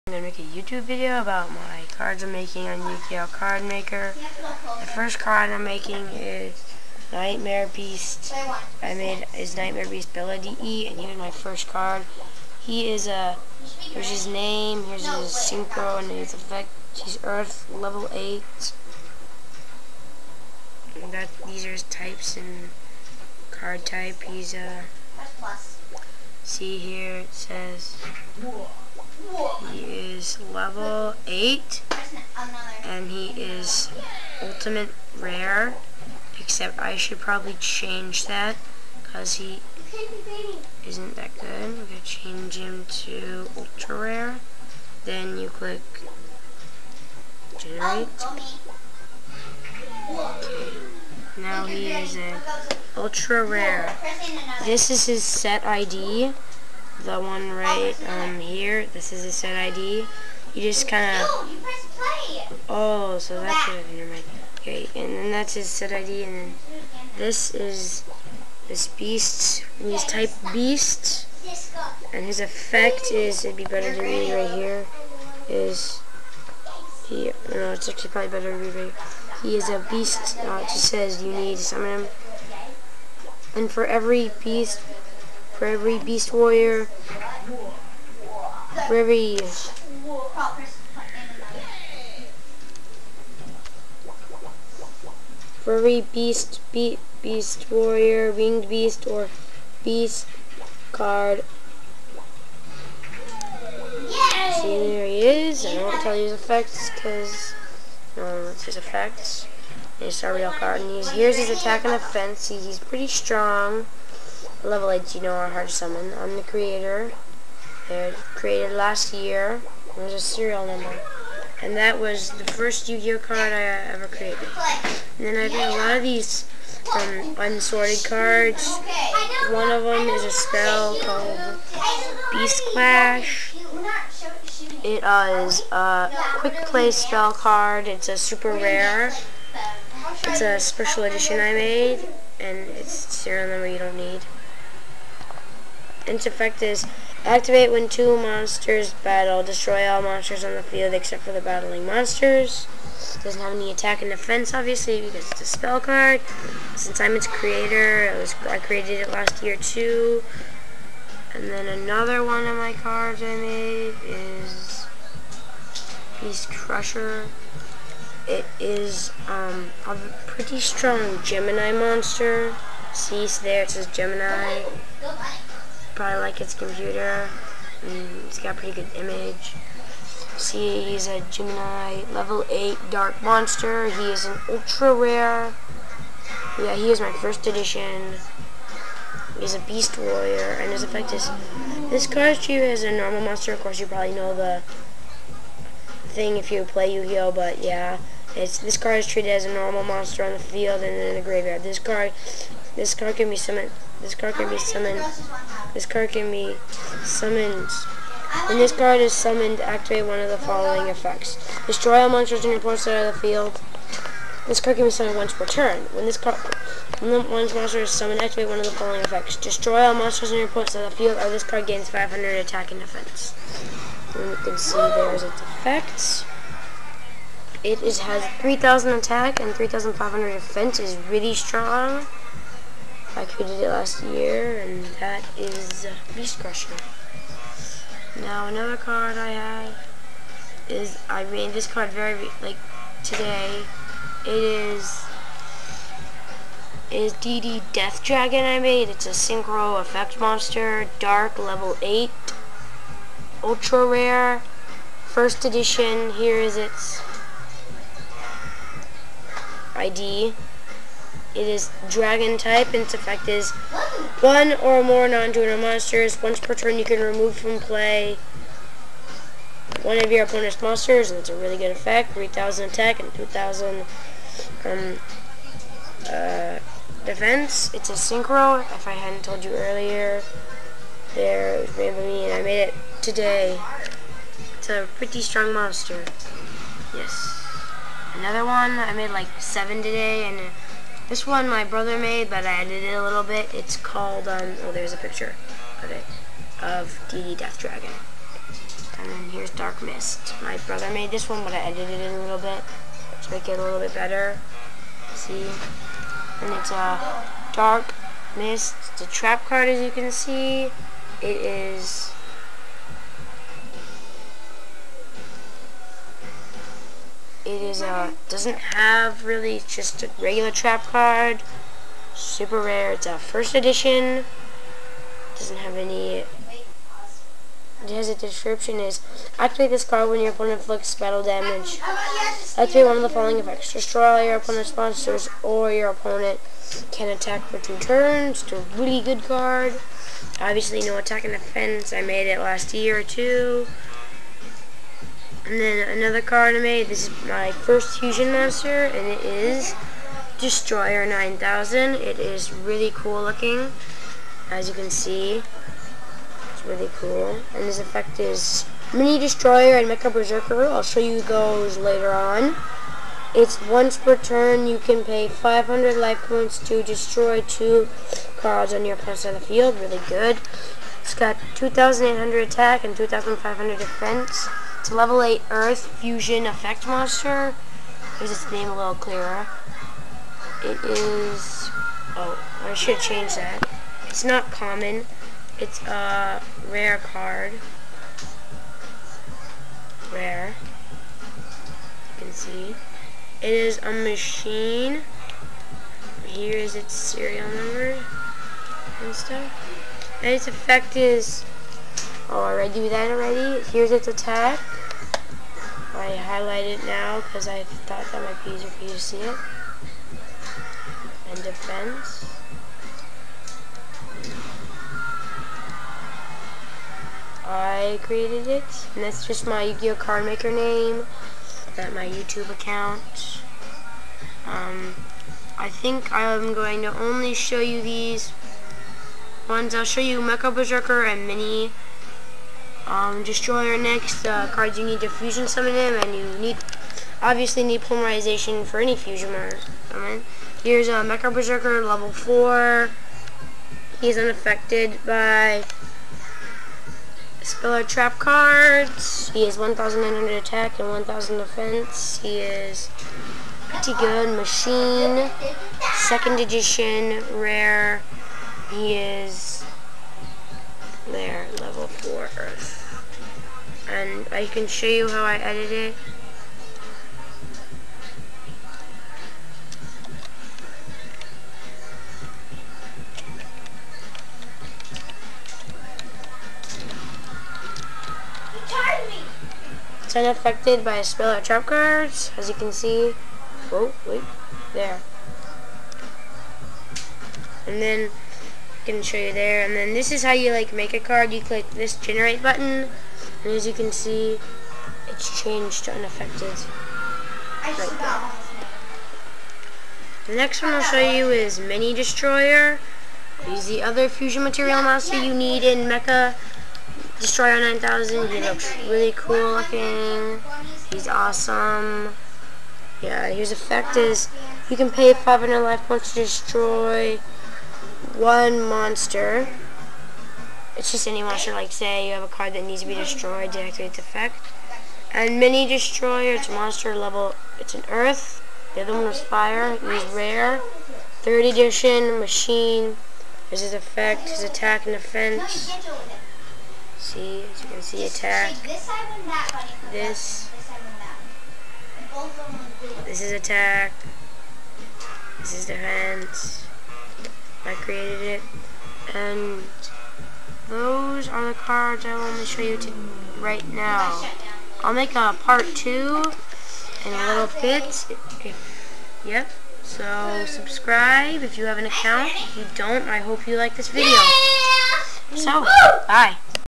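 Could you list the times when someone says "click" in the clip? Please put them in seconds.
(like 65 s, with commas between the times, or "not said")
45 s, 491 s.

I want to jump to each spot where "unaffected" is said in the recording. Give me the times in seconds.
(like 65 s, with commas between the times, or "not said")
444 s, 480 s, 495 s.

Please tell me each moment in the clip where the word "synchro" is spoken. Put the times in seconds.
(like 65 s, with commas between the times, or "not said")
15 s, 249 s, 277 s.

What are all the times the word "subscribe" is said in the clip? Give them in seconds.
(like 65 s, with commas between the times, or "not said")
560 s.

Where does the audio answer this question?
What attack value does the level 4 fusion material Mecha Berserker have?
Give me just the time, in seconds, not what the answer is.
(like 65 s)
449 s.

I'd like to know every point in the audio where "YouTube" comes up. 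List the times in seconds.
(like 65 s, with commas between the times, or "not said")
0 s, 422 s.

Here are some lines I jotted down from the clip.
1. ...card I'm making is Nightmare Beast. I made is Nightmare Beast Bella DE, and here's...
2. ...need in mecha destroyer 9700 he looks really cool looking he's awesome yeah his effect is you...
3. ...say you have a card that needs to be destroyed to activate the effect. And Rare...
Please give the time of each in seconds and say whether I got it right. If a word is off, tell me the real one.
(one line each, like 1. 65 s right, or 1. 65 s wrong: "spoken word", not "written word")
1. 5 s right
2. 505 s wrong: "9000", not "9700"
3. 521 s wrong: "Mini", not "Rare".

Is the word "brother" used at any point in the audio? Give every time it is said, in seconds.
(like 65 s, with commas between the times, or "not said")
291 s, 300 s.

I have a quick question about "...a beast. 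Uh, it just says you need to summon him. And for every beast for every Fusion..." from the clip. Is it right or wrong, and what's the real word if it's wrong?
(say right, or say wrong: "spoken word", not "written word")
wrong: "Beast", not "Fusion".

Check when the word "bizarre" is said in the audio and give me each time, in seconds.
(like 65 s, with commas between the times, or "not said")
not said.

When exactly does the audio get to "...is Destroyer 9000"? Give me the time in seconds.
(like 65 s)
349 s.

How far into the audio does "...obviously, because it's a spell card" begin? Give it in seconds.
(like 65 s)
154 s.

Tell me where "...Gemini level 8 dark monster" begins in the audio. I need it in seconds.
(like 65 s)
181 s.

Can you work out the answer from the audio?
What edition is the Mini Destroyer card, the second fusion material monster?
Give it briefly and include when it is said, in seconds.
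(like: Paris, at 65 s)
Third edition, at 531 s.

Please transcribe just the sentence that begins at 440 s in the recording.
Here's a uh, Mecha Berserker level 4.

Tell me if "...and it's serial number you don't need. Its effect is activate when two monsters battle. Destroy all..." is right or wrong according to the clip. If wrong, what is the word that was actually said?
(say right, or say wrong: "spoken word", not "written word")
right.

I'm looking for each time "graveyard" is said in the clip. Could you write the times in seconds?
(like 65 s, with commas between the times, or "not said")
201 s.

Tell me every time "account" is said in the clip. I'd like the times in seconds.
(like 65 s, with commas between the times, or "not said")
422 s, 561 s.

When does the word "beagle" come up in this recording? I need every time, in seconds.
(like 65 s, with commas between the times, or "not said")
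not said.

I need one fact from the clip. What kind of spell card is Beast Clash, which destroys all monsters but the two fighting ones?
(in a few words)
Quick play.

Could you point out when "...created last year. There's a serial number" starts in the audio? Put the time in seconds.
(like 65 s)
118 s.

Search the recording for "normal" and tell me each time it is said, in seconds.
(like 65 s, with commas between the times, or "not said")
192 s, 199 s.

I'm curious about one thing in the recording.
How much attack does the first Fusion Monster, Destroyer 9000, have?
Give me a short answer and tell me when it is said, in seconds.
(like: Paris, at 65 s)
2,800, at 371 s.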